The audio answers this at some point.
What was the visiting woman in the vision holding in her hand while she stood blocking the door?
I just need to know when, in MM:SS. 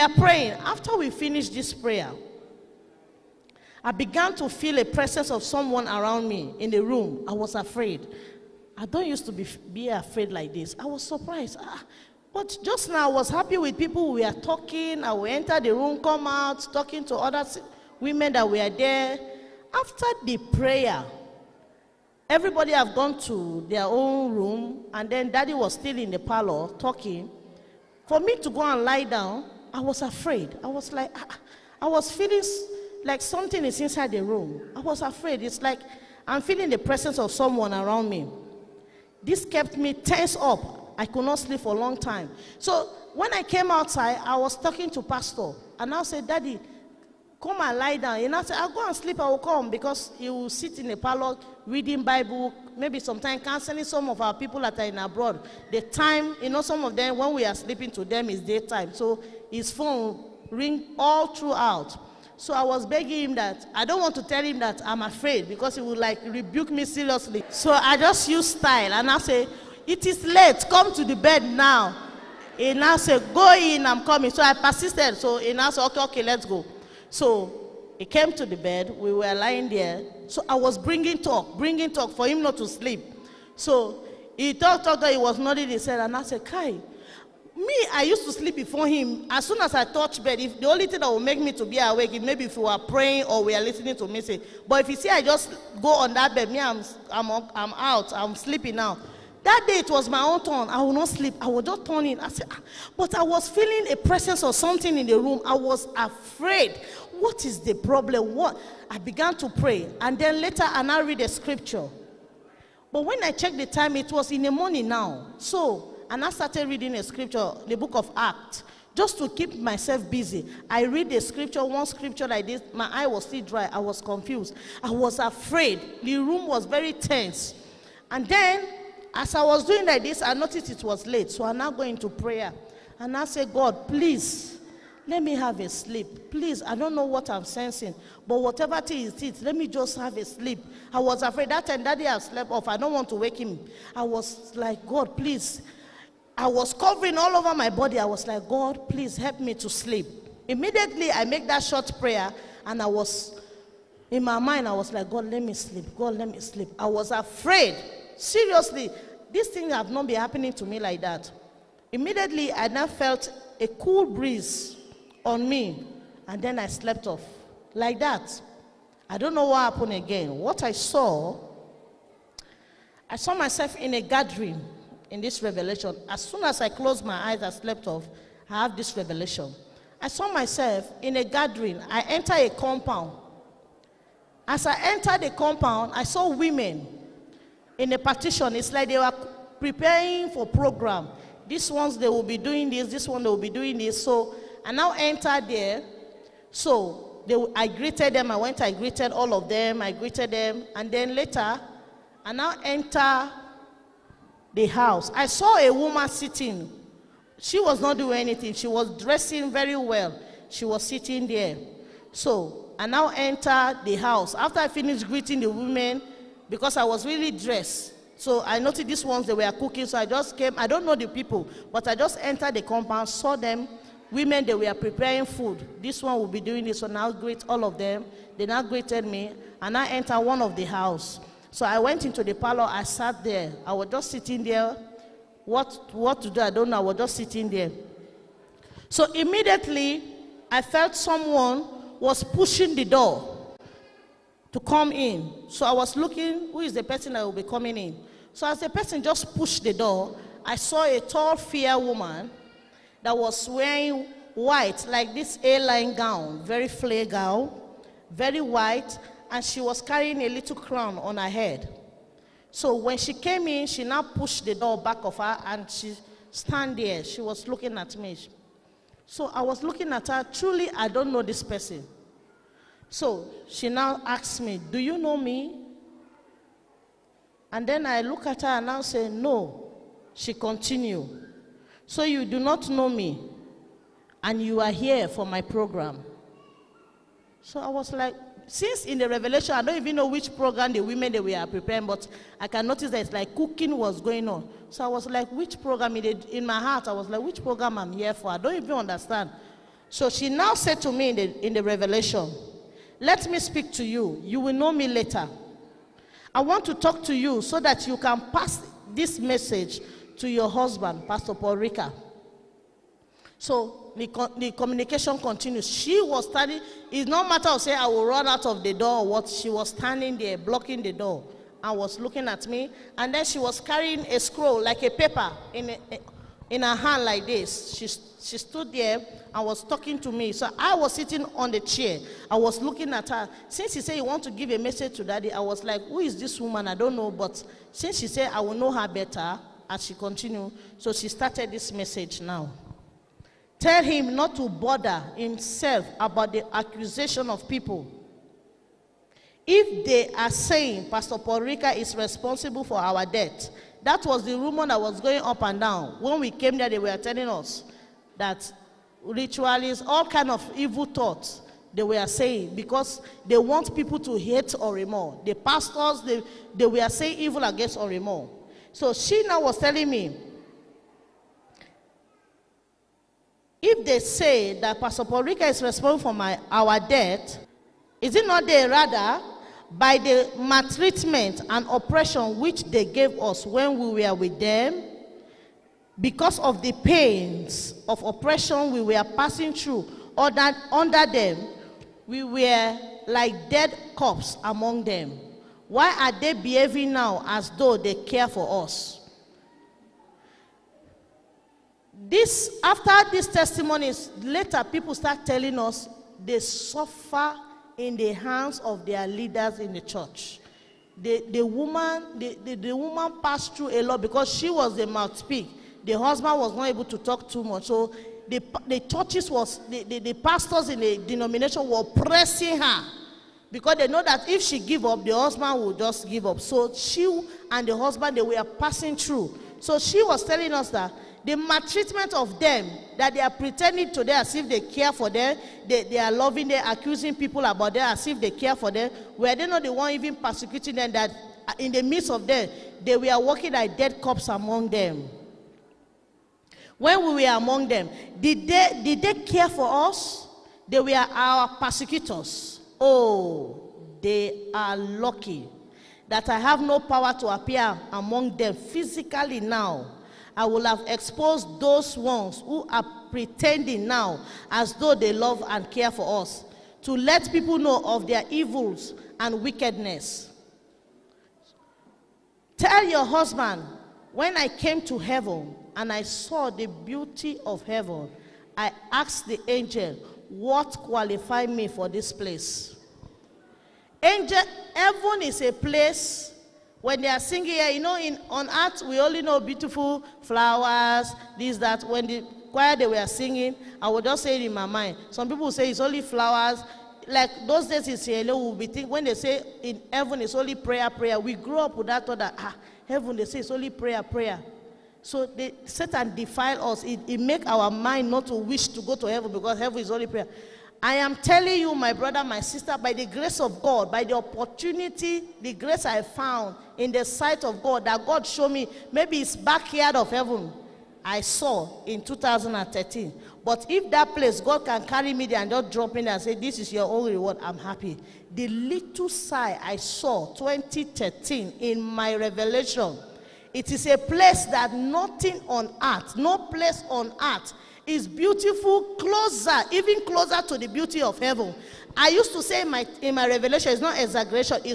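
05:24.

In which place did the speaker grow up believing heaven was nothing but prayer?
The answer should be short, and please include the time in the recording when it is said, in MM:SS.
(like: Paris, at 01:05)
Sierra, at 08:17.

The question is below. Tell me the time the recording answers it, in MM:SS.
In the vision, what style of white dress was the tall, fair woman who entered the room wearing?
04:15.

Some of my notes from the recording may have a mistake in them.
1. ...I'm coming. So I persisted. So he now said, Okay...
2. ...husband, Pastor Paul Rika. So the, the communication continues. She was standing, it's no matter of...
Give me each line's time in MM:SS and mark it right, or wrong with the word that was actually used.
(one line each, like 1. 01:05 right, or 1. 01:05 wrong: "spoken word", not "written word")
1. 01:13 right
2. 05:10 right.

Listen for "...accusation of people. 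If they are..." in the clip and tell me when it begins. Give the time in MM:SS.
05:46.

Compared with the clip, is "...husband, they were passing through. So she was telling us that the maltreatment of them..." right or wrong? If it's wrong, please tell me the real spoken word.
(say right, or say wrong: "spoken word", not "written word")
right.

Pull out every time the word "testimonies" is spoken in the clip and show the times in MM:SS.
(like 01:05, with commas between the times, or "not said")
06:43.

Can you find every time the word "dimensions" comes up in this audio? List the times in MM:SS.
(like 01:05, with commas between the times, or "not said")
not said.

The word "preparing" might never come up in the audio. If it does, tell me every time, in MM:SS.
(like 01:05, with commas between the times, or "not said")
03:09, 03:44, 04:51.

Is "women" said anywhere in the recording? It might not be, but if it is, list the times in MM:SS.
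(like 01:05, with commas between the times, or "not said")
00:17, 03:06, 03:35, 03:44, 04:50.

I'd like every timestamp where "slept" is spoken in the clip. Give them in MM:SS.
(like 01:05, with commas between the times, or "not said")
02:22, 02:46, 02:57.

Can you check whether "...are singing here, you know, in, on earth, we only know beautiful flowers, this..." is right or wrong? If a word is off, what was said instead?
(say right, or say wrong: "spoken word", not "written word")
right.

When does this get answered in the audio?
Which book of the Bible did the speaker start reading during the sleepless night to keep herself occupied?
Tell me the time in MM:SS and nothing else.
01:57.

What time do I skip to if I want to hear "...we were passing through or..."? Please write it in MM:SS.
06:28.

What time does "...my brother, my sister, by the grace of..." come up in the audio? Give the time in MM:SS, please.
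08:31.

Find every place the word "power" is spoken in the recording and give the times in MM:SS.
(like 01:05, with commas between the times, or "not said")
07:36.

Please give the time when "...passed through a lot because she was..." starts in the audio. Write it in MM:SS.
06:53.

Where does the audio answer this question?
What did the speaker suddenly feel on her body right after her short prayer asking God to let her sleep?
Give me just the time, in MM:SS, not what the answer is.
02:43.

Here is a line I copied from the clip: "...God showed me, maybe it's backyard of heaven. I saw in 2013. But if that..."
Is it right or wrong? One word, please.
right.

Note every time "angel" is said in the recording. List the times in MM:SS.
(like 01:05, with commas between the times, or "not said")
07:59, 08:04.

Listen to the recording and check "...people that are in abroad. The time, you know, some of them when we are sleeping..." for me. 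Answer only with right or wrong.
right.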